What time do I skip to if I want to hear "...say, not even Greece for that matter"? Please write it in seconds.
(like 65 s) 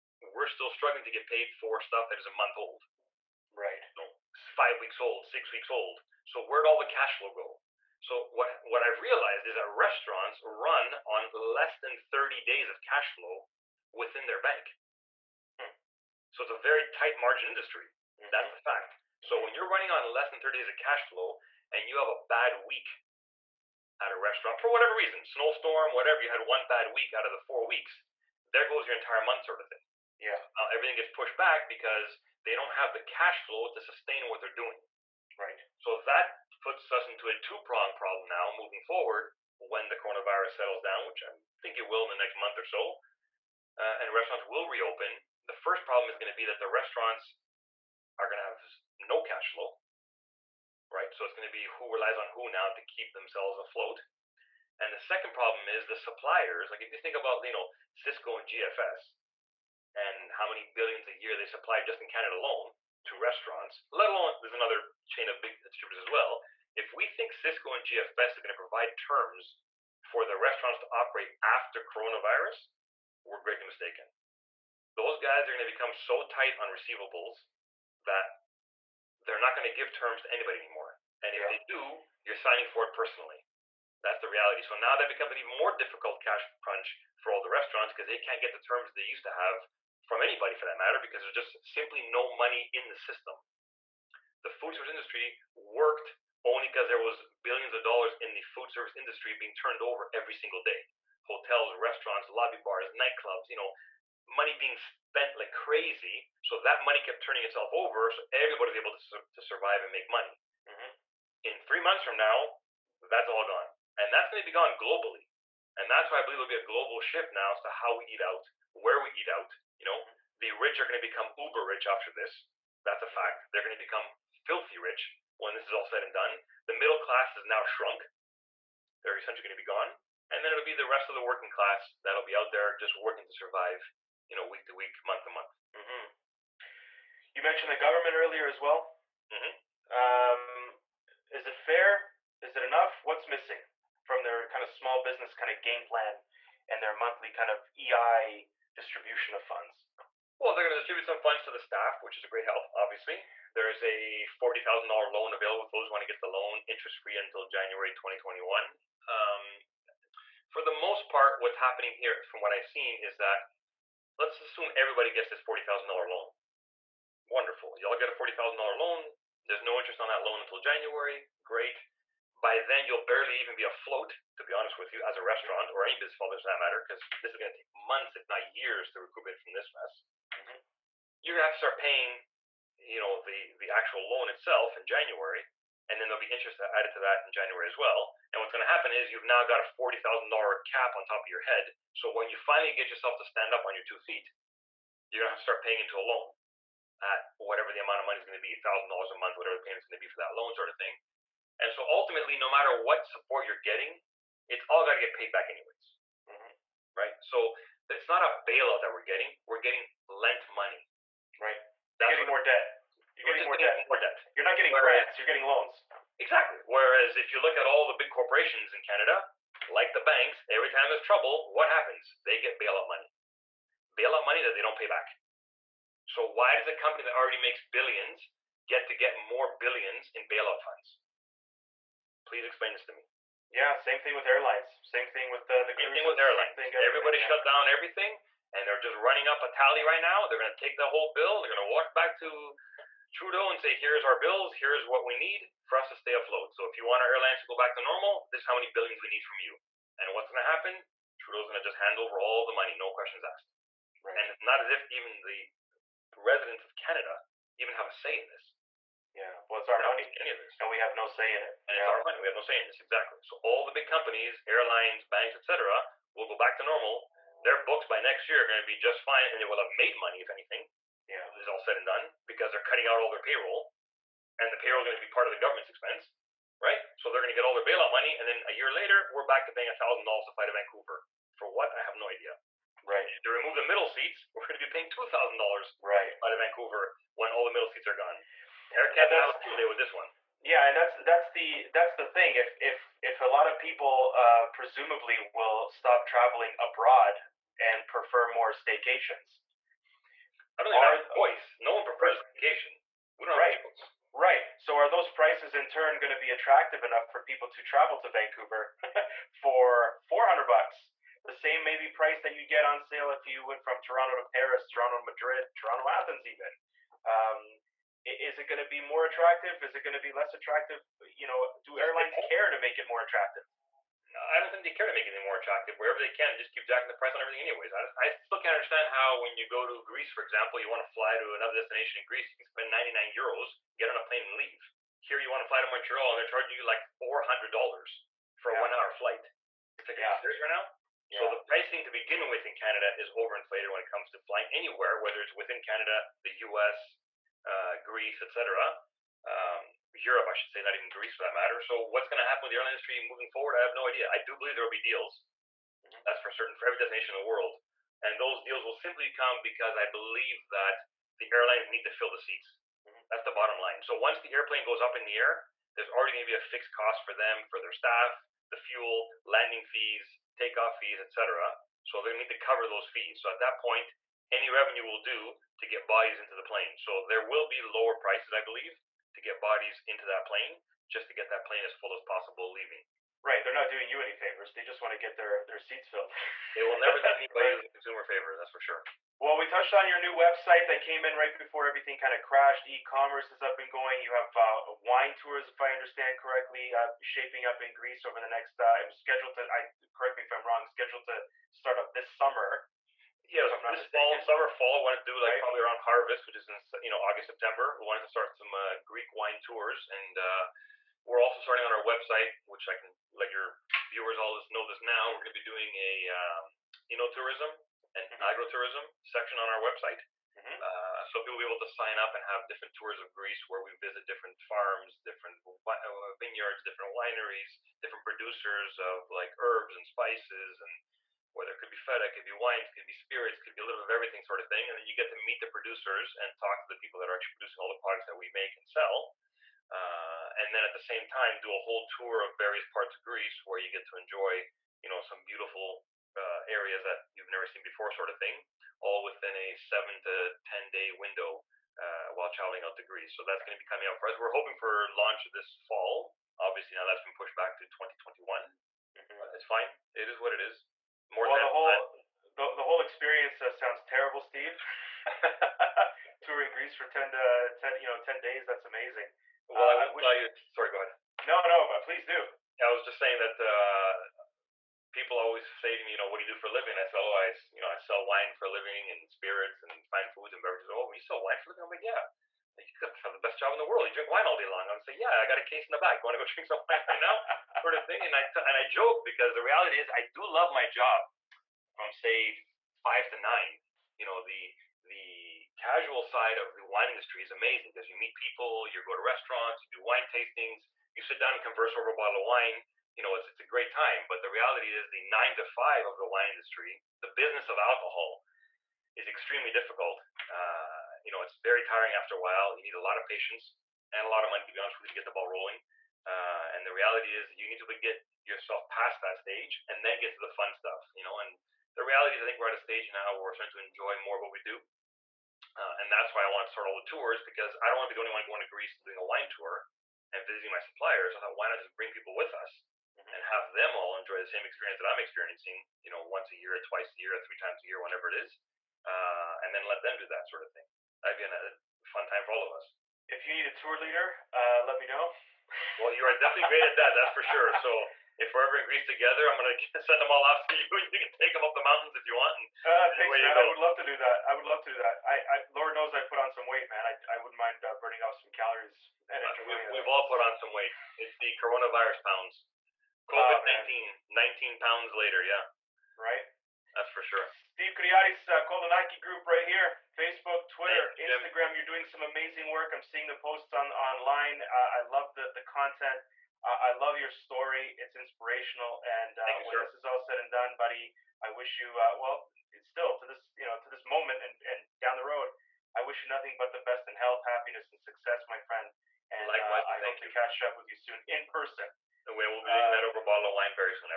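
350 s.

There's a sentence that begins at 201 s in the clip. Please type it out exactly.
And so ultimately, no matter what support you're getting, it's all got to get paid back anyways, mm-hmm.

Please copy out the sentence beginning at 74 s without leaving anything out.
Those guys are going to become so tight on receivables that they're not going to give terms to anybody anymore.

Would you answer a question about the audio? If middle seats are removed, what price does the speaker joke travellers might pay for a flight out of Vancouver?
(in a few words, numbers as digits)
$2,000.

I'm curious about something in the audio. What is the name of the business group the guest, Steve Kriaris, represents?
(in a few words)
Kolonaki group.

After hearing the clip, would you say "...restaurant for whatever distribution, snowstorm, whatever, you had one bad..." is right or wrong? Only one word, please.
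wrong.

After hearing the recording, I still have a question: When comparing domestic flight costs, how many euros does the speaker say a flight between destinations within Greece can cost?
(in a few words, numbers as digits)
99 euros.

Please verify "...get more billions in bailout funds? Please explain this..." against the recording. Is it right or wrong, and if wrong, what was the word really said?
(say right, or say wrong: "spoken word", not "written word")
right.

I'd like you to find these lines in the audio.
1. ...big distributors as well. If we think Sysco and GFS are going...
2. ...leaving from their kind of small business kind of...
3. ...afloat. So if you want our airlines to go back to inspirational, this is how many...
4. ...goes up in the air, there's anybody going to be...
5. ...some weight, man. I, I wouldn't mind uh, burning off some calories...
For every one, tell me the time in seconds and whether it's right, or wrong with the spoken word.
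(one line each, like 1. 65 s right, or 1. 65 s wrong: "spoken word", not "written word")
1. 65 s right
2. 143 s wrong: "missing", not "leaving"
3. 246 s wrong: "normal", not "inspirational"
4. 364 s wrong: "already", not "anybody"
5. 556 s right.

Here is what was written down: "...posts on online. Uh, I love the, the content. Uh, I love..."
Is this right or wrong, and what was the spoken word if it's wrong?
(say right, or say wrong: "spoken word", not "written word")
right.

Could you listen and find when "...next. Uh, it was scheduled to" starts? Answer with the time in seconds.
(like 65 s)
398 s.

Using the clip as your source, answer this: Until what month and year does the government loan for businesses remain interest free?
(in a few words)
January 2021.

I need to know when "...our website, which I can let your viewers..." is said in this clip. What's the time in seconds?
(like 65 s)
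411 s.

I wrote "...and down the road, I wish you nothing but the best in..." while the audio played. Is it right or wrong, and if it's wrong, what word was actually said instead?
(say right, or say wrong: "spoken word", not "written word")
right.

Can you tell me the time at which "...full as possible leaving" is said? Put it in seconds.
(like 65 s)
381 s.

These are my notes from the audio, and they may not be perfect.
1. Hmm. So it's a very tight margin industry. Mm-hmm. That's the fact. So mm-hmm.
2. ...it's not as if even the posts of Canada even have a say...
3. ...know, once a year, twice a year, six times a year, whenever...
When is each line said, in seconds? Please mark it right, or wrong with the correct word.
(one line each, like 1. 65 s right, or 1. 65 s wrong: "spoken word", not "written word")
1. 15 s right
2. 254 s wrong: "residents", not "posts"
3. 535 s wrong: "three", not "six".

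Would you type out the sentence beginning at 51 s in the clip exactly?
So it's going to be who relies on who now to keep themselves afloat.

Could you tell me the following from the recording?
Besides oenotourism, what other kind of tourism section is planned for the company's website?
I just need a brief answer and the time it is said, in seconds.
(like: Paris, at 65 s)
agrotourism, at 418 s.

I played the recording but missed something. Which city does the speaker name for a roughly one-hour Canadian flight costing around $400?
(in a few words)
Montreal.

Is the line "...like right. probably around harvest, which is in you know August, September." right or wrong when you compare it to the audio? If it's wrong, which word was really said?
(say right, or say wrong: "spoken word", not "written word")
right.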